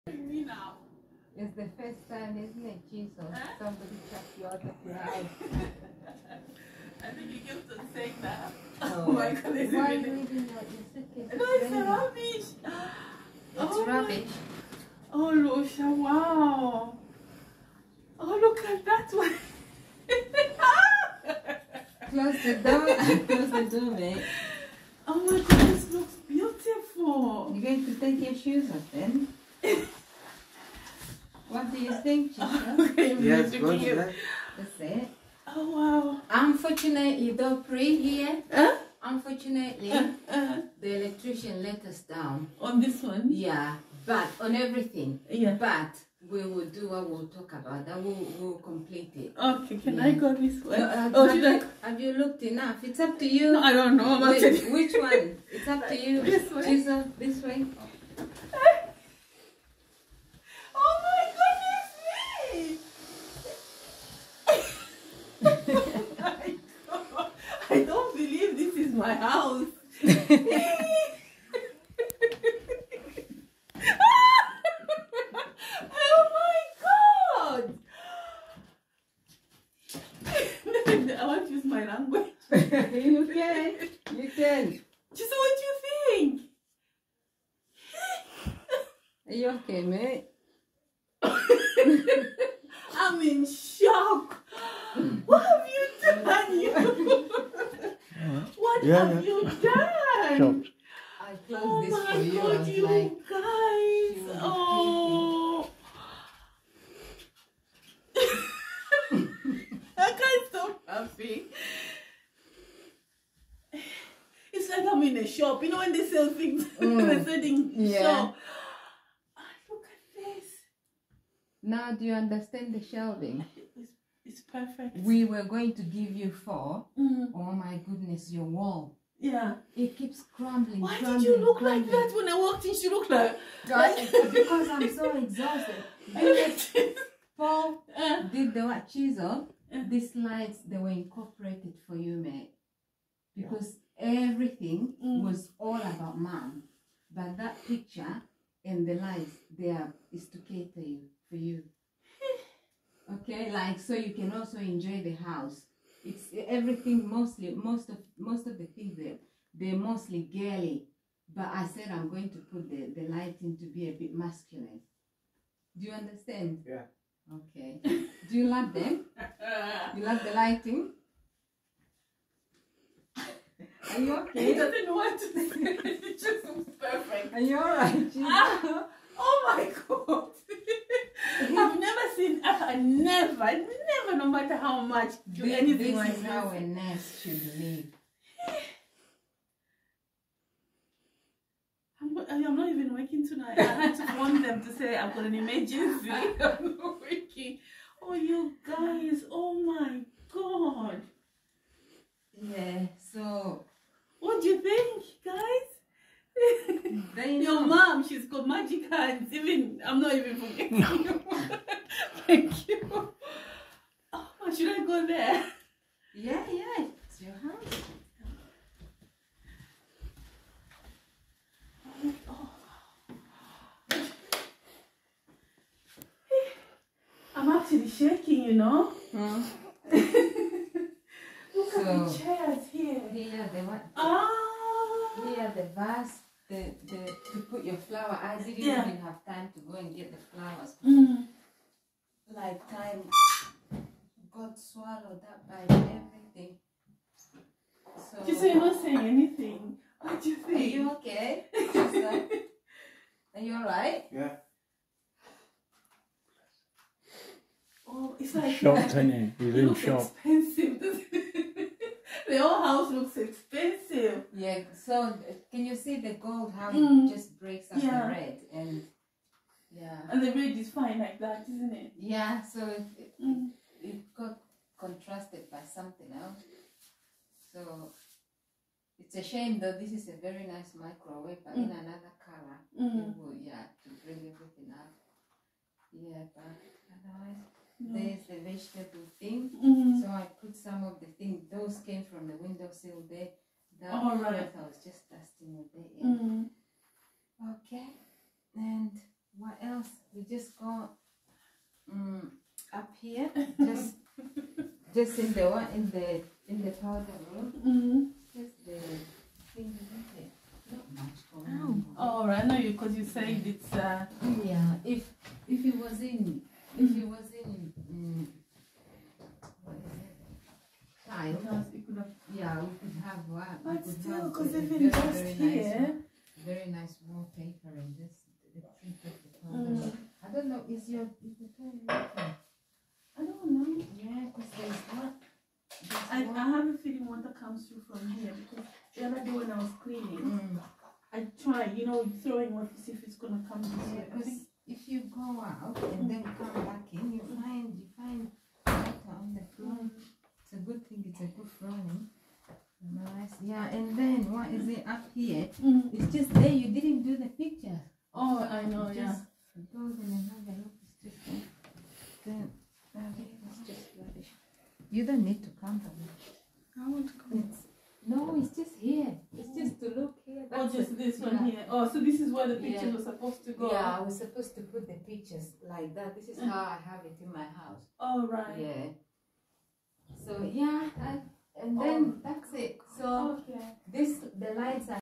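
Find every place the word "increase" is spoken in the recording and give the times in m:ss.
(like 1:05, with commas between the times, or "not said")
not said.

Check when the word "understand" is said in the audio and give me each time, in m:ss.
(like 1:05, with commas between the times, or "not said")
2:02, 2:45.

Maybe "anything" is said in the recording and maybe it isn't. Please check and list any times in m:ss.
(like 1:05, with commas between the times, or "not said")
3:05, 4:08.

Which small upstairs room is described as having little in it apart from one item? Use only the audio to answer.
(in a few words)
The powder room.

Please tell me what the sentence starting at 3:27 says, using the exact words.
Your mom, she's got magic hands.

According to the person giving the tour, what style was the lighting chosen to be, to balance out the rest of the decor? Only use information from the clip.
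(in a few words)
Masculine.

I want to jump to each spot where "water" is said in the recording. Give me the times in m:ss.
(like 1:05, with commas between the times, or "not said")
5:37, 5:42, 5:48.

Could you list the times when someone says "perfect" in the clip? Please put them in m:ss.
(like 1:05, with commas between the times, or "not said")
2:04, 2:56.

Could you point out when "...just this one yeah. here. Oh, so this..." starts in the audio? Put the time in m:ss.
6:10.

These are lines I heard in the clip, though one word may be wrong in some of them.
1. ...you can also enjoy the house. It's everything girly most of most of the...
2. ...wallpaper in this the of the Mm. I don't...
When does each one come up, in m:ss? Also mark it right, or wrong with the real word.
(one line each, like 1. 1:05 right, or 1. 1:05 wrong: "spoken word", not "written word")
1. 2:33 wrong: "mostly", not "girly"
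2. 5:27 right.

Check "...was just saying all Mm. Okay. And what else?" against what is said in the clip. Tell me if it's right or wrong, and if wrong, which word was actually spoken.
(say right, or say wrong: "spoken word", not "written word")
wrong: "dusting", not "saying".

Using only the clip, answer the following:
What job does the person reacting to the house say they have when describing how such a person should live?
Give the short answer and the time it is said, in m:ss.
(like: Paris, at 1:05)
Nurse, at 3:06.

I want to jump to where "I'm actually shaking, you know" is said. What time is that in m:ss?
3:47.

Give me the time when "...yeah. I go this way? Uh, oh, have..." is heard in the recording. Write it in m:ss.
0:49.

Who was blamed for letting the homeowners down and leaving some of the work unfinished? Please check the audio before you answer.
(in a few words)
The electrician.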